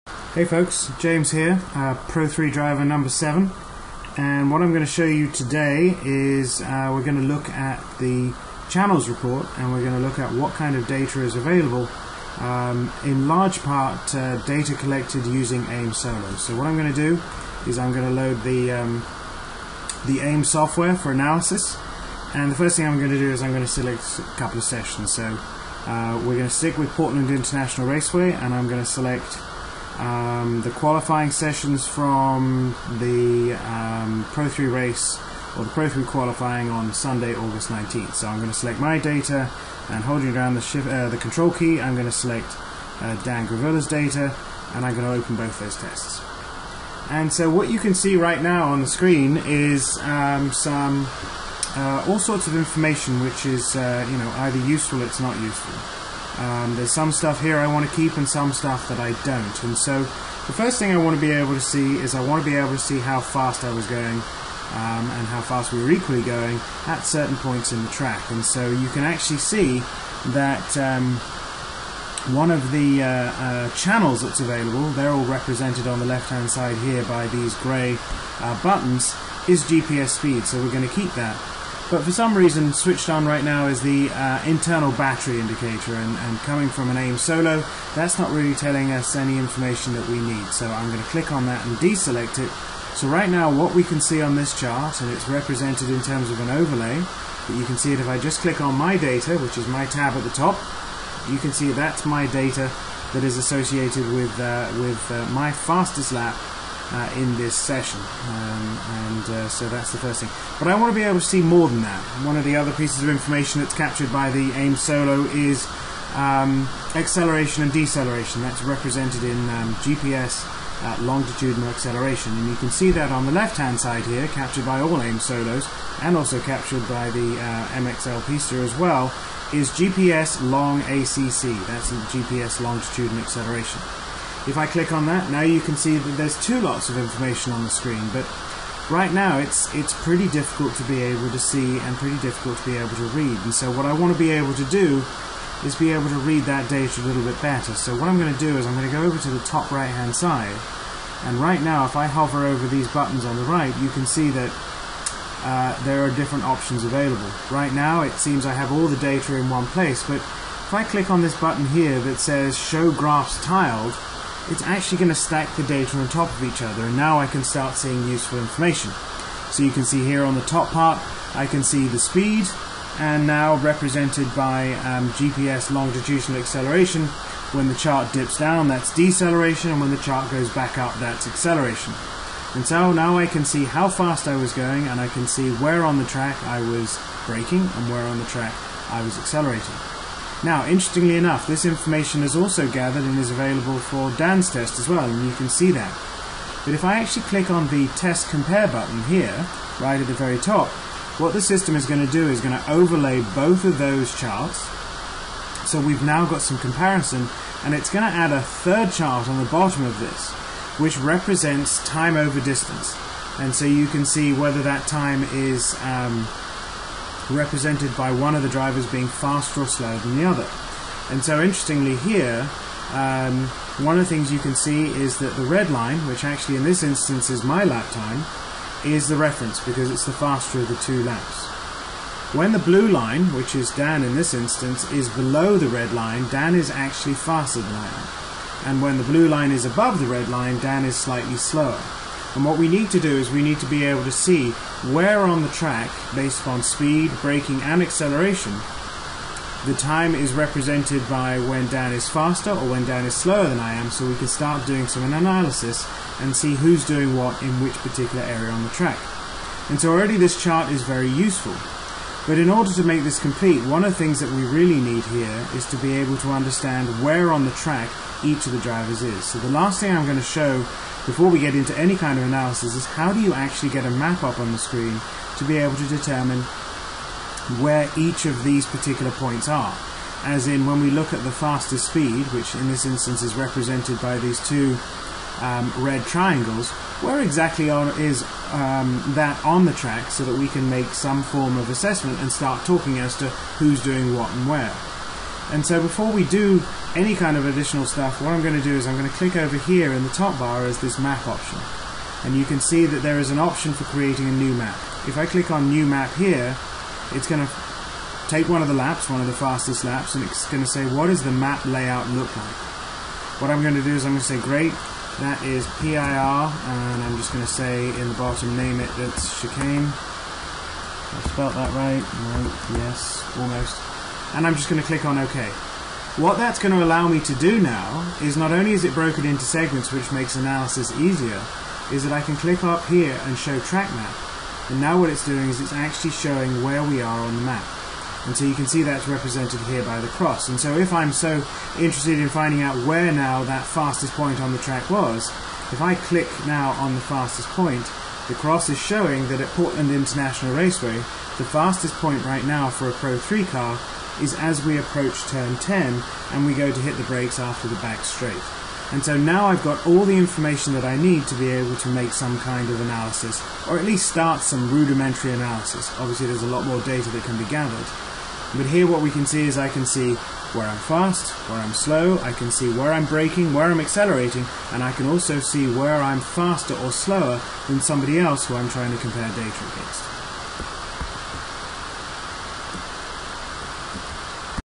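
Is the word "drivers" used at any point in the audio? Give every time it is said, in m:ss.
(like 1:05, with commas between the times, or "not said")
0:02, 3:38, 4:28.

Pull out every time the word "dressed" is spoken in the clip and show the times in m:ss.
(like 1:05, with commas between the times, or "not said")
not said.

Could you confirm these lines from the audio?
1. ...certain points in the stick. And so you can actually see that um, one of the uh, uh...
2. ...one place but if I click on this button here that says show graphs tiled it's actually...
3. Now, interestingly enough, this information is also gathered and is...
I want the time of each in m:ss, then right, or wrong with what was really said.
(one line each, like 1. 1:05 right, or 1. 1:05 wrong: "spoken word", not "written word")
1. 1:07 wrong: "track", not "stick"
2. 2:39 right
3. 3:10 right.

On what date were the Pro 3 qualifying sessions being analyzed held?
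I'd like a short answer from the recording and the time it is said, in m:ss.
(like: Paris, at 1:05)
Sunday, August 19th, at 0:36.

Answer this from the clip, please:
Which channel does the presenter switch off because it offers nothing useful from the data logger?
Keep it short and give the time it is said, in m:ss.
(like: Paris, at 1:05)
Internal battery indicator, at 1:24.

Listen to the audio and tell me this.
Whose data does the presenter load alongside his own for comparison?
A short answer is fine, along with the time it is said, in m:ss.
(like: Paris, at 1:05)
Dan Gravella, at 0:43.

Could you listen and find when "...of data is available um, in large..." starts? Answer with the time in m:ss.
0:10.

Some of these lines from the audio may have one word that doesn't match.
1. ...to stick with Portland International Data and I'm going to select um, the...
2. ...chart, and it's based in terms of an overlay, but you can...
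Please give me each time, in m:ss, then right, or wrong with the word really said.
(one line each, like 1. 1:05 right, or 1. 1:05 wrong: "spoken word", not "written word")
1. 0:26 wrong: "Raceway", not "Data"
2. 1:34 wrong: "represented", not "based".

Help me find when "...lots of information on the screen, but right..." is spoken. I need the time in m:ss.
2:16.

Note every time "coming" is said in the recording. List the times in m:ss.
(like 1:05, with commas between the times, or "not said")
1:26.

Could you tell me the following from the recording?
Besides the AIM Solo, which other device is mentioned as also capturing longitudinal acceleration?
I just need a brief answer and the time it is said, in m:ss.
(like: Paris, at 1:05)
MXL Pista, at 2:07.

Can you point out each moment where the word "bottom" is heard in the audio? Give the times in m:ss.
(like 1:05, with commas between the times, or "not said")
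3:29, 5:18.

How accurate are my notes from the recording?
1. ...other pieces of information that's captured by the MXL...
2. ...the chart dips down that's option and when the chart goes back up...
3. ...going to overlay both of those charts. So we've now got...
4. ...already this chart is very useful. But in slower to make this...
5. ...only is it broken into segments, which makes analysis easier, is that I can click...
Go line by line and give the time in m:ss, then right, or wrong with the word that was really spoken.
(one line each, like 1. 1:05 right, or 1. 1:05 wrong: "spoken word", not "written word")
1. 1:52 wrong: "AIM", not "MXL"
2. 2:57 wrong: "deceleration", not "option"
3. 3:22 right
4. 4:19 wrong: "order", not "slower"
5. 5:28 right.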